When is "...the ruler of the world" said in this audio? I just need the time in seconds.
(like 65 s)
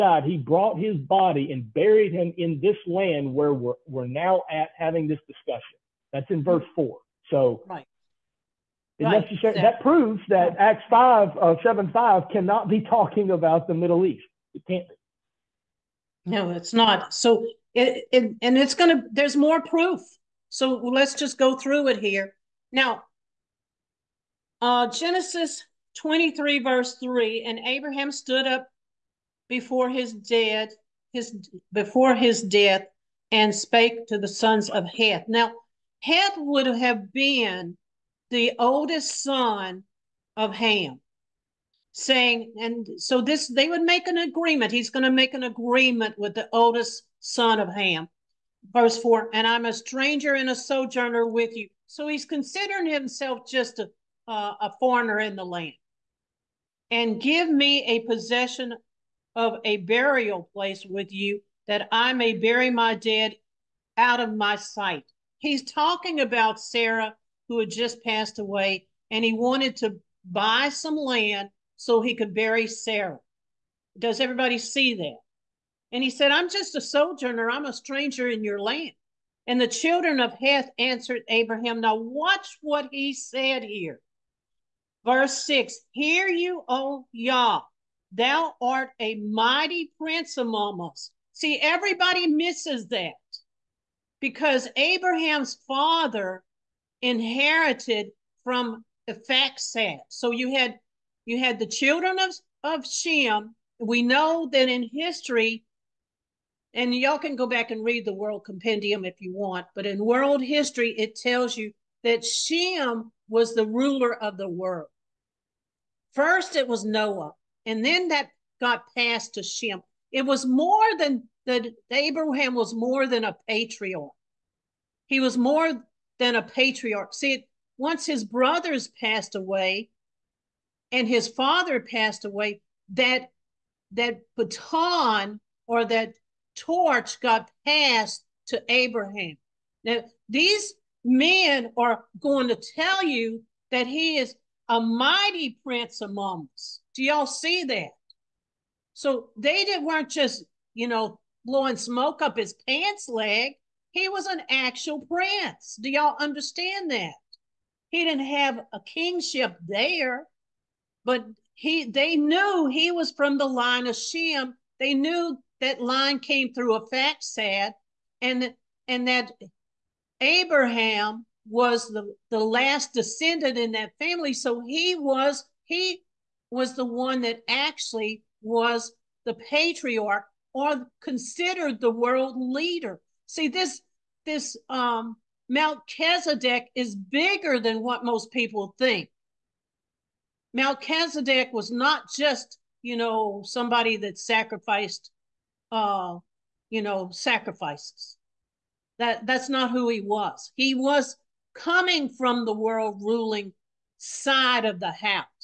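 113 s.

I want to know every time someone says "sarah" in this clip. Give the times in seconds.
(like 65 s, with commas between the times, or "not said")
66 s, 72 s.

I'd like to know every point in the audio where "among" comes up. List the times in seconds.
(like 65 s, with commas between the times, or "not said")
90 s, 146 s.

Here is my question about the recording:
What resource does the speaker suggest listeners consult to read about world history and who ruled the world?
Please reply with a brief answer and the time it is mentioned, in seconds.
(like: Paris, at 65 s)
World Compendium, at 108 s.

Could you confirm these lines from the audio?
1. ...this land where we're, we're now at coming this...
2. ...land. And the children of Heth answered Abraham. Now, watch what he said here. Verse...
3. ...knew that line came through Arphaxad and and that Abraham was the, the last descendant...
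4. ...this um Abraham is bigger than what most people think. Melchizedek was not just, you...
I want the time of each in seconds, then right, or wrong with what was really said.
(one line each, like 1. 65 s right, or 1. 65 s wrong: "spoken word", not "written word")
1. 2 s wrong: "having", not "coming"
2. 78 s right
3. 164 s right
4. 184 s wrong: "Melchizedek", not "Abraham".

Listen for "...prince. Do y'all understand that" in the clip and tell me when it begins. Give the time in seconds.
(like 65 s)
155 s.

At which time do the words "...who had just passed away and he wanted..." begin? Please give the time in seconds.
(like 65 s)
67 s.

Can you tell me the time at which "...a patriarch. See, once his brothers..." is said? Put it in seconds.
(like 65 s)
126 s.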